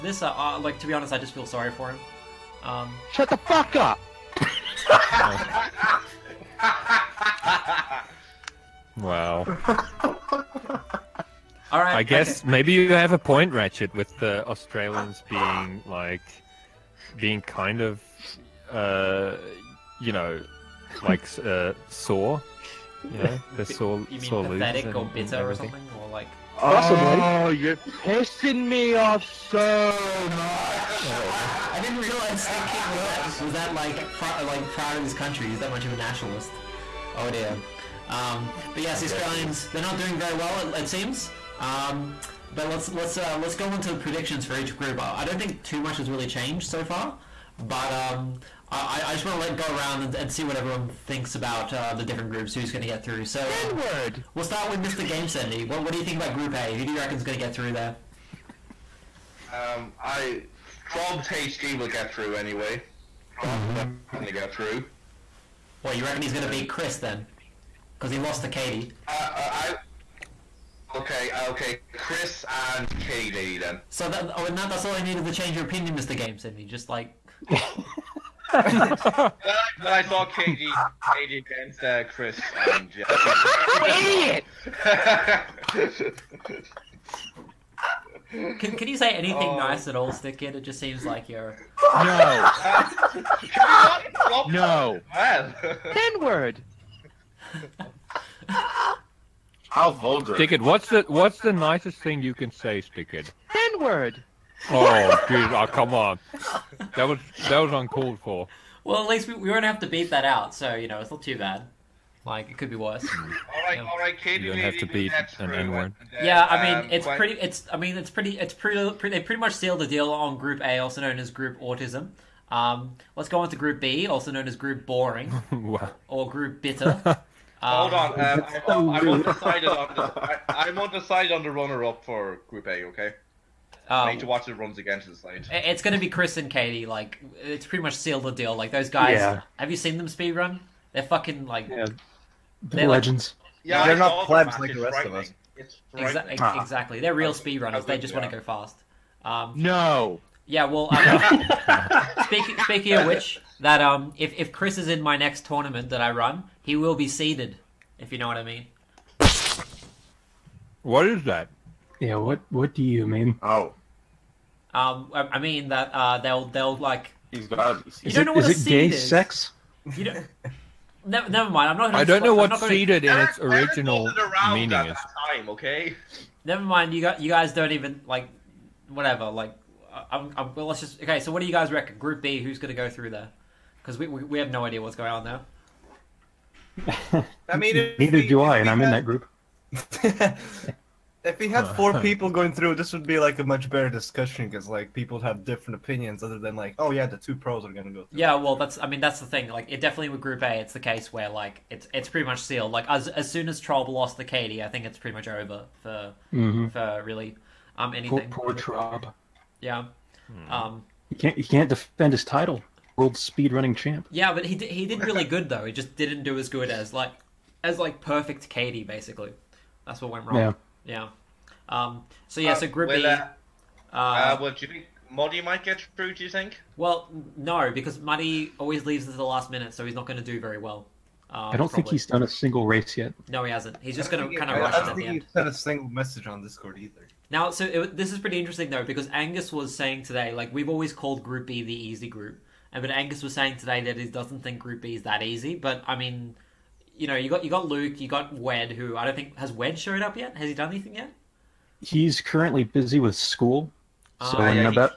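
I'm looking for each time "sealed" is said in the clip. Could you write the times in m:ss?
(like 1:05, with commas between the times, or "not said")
1:59, 2:17, 3:22.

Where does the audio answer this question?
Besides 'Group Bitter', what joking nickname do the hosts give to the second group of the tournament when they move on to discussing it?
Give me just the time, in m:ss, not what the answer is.
2:04.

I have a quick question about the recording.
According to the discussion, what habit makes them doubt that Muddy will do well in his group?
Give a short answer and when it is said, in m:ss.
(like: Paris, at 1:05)
leaves at the last minute, at 3:48.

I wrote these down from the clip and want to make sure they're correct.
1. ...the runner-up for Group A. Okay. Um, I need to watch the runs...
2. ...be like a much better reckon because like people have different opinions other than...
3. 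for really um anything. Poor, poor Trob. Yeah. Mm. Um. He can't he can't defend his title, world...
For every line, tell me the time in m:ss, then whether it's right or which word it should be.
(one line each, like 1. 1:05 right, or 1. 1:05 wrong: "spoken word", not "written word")
1. 2:11 right
2. 3:13 wrong: "discussion", not "reckon"
3. 3:26 right.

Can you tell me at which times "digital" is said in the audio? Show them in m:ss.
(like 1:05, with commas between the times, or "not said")
not said.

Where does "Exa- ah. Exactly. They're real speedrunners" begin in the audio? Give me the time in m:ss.
2:25.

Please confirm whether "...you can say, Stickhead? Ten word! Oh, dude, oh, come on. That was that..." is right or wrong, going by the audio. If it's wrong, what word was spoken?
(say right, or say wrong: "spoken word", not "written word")
right.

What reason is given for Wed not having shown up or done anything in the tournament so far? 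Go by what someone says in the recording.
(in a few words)
busy with school.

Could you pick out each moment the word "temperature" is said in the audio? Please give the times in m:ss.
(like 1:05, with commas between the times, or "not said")
not said.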